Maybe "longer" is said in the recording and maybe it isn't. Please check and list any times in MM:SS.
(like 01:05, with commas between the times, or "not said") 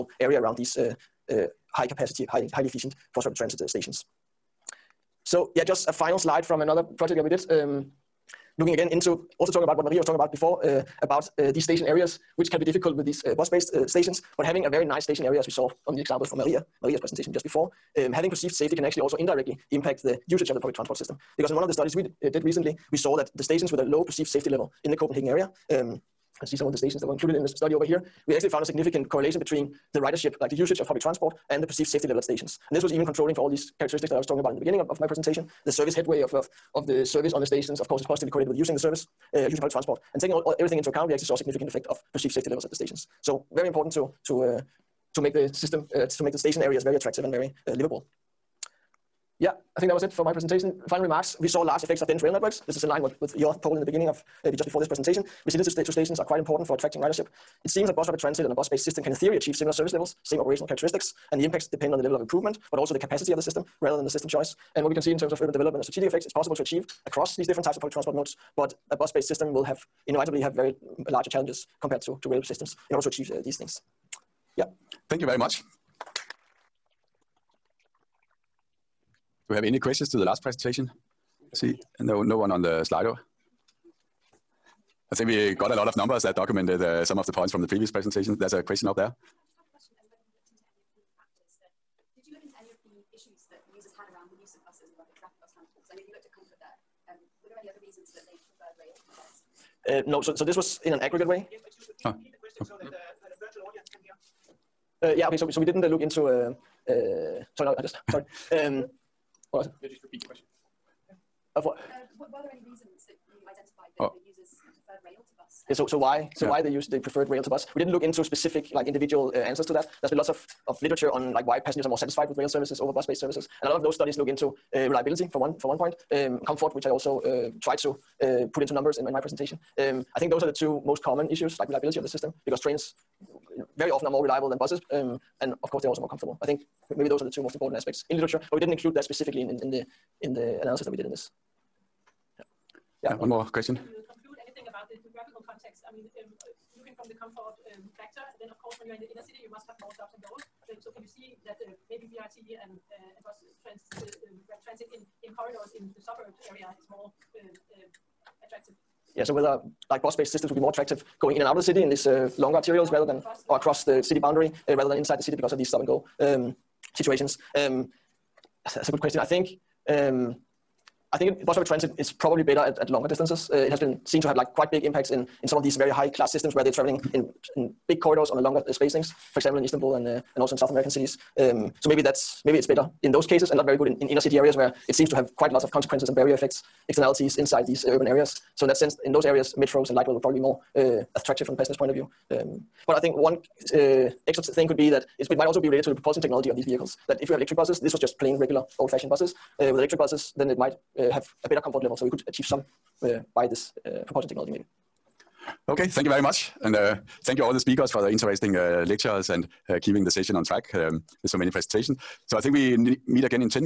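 02:42, 02:52, 02:58.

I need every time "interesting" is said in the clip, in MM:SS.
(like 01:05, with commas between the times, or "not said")
03:28.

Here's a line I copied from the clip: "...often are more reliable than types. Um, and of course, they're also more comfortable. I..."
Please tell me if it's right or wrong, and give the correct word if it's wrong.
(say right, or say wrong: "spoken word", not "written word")
wrong: "buses", not "types".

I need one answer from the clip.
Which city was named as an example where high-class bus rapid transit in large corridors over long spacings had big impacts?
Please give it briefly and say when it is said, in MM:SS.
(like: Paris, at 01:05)
Istanbul, at 02:59.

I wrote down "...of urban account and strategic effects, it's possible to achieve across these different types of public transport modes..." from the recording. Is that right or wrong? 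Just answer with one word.
wrong.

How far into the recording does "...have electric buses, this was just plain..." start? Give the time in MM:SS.
03:17.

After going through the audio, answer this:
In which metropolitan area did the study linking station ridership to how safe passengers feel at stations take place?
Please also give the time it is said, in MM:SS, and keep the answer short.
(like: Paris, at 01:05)
Copenhagen, at 00:24.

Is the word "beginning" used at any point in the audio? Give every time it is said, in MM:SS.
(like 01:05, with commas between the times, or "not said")
00:34, 00:53.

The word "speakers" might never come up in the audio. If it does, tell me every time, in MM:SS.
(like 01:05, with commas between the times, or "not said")
03:27.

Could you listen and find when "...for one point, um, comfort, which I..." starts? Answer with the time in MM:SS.
02:05.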